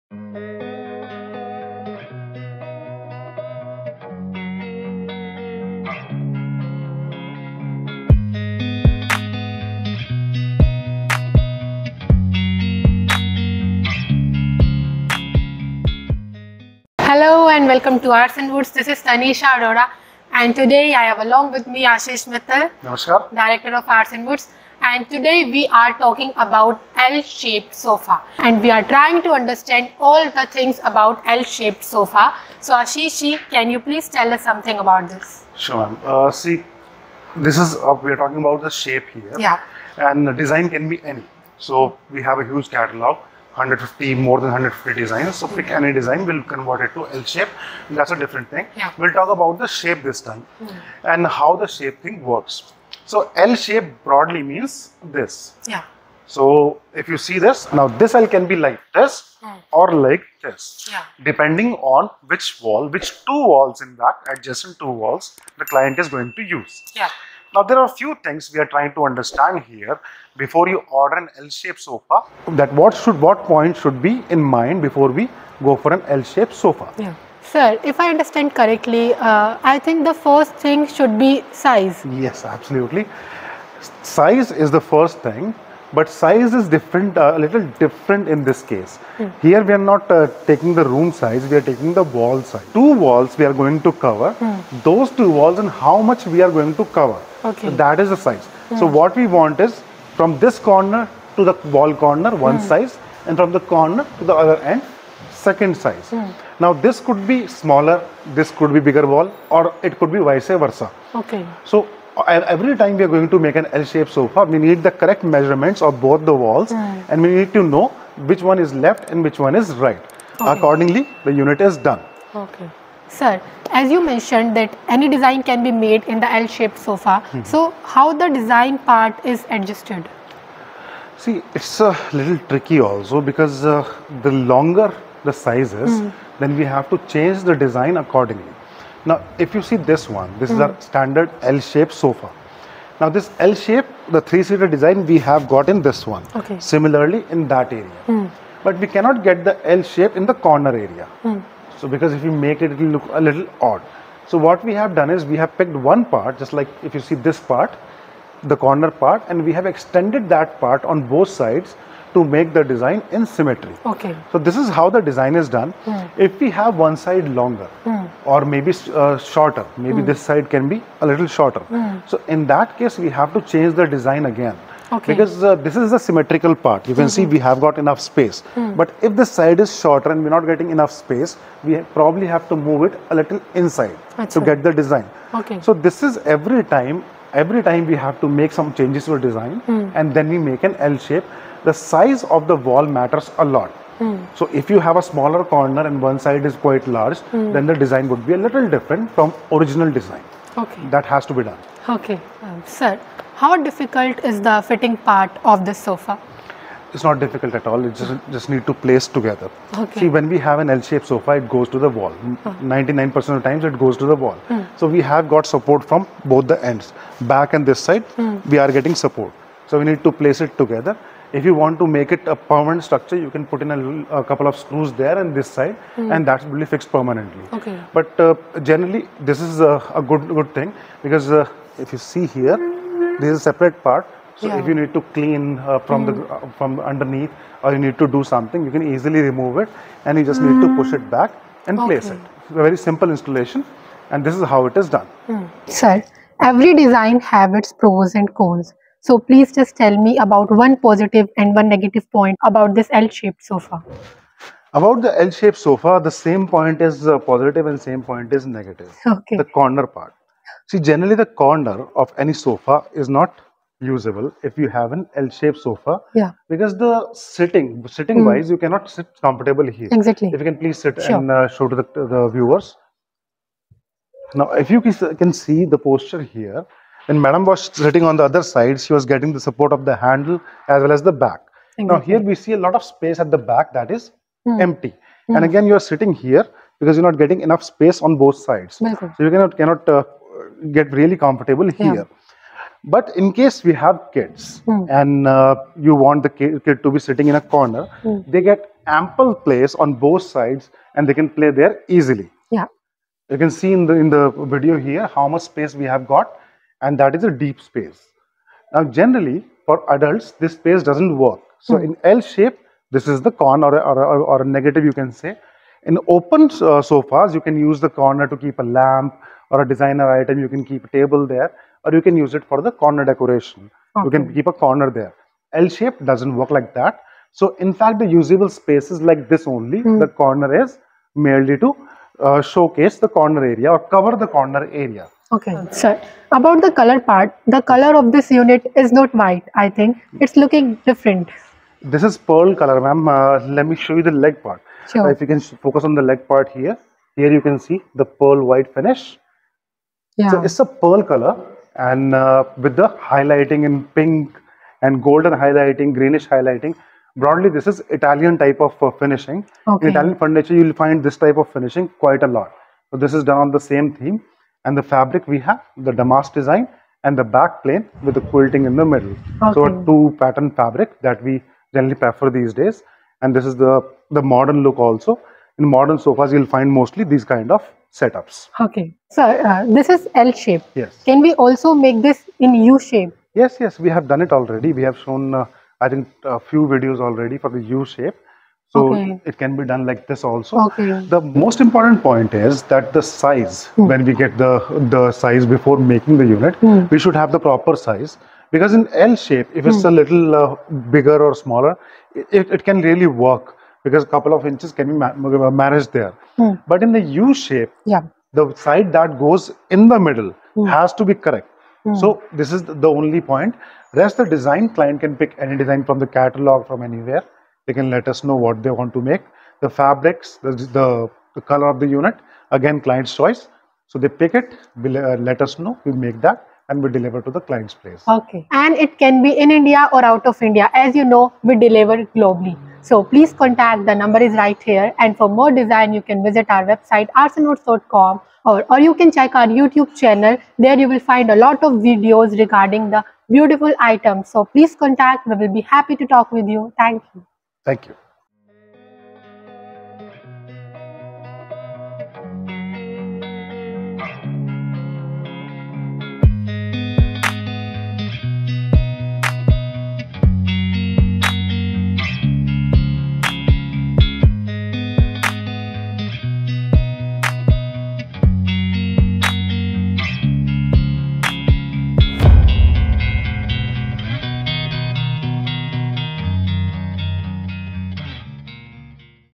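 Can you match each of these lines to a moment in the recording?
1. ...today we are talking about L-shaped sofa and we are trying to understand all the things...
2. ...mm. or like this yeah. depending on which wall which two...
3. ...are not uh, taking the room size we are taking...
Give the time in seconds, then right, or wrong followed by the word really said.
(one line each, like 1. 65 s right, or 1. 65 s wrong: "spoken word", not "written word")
1. 25 s right
2. 59 s right
3. 89 s right.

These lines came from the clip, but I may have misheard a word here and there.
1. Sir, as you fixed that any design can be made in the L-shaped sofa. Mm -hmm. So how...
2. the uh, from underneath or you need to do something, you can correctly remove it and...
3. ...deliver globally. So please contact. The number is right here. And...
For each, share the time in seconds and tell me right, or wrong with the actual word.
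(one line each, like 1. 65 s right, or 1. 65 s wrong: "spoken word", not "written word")
1. 123 s wrong: "mentioned", not "fixed"
2. 236 s wrong: "easily", not "correctly"
3. 431 s right.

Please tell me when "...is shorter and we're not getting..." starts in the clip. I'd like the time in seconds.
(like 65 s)
179 s.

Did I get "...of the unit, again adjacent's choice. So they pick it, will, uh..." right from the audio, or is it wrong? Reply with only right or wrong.
wrong.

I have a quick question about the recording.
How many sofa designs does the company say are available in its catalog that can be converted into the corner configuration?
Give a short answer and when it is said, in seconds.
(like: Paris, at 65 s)
more than 150, at 44 s.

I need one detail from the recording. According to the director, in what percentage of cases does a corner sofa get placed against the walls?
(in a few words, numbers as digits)
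99%.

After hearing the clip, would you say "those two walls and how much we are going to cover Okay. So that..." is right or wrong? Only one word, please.
right.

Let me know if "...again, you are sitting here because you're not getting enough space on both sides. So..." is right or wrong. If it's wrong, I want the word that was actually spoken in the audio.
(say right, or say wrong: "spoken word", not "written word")
right.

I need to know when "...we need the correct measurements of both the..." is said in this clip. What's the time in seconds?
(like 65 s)
114 s.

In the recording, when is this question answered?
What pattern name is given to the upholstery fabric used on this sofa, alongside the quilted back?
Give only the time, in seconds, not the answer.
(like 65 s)
365 s.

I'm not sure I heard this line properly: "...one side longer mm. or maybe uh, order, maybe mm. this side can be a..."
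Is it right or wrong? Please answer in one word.
wrong.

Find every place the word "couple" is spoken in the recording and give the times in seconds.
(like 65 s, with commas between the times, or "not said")
224 s, 404 s.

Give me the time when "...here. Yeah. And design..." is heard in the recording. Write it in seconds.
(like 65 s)
39 s.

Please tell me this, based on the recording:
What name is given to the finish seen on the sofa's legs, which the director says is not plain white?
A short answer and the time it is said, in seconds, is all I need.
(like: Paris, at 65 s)
pearl white, at 348 s.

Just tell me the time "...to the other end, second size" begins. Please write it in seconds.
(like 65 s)
104 s.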